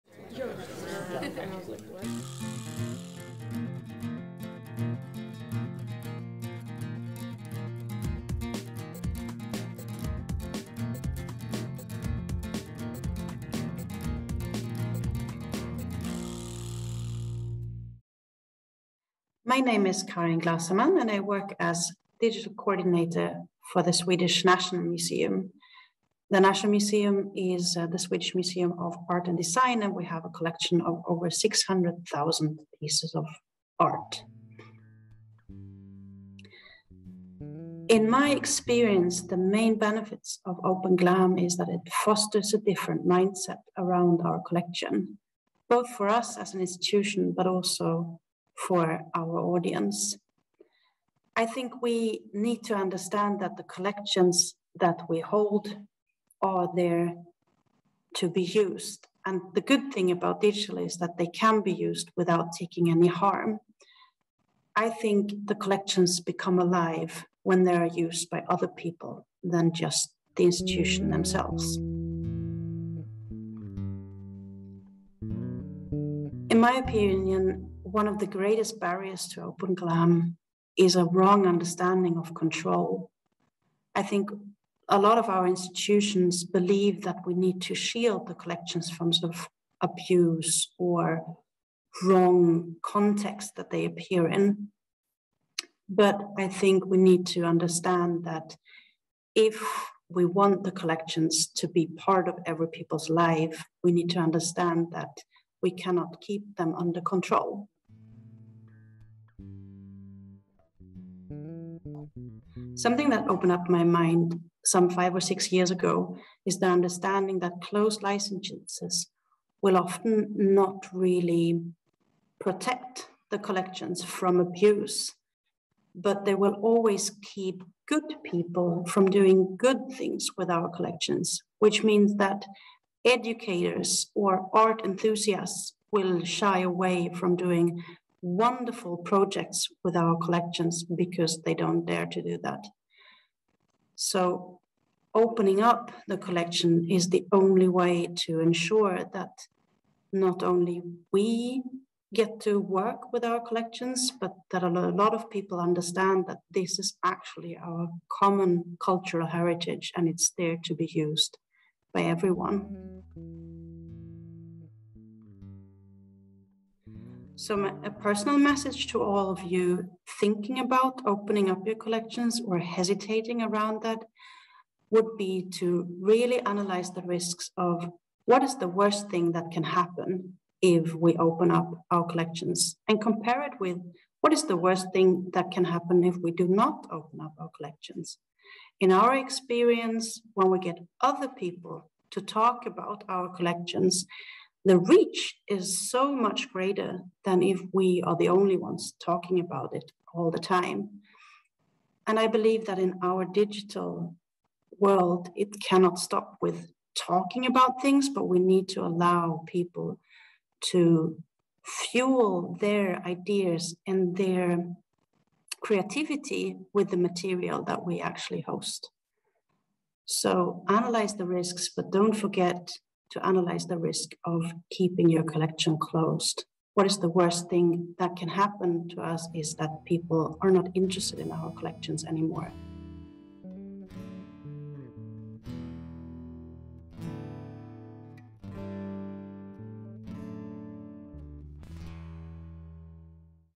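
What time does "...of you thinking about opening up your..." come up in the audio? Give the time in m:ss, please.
2:49.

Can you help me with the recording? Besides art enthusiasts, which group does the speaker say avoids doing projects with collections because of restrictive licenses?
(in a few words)
Educators.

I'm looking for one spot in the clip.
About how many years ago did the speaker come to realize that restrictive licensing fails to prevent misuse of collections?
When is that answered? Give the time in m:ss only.
1:54.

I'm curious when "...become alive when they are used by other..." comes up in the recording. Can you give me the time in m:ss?
1:06.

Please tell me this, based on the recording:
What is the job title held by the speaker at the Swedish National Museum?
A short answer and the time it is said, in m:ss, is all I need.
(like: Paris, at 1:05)
Digital coordinator, at 0:22.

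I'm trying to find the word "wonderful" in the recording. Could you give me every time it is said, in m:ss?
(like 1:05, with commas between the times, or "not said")
2:18.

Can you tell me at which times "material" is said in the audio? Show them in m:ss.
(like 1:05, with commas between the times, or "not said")
3:36.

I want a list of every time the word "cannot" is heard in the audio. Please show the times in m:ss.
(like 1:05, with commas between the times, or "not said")
1:45, 3:25.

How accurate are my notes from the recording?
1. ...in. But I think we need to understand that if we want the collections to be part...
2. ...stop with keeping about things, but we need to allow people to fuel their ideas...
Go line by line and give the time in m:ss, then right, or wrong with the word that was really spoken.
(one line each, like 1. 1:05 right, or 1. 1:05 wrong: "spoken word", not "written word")
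1. 1:34 right
2. 3:25 wrong: "talking", not "keeping".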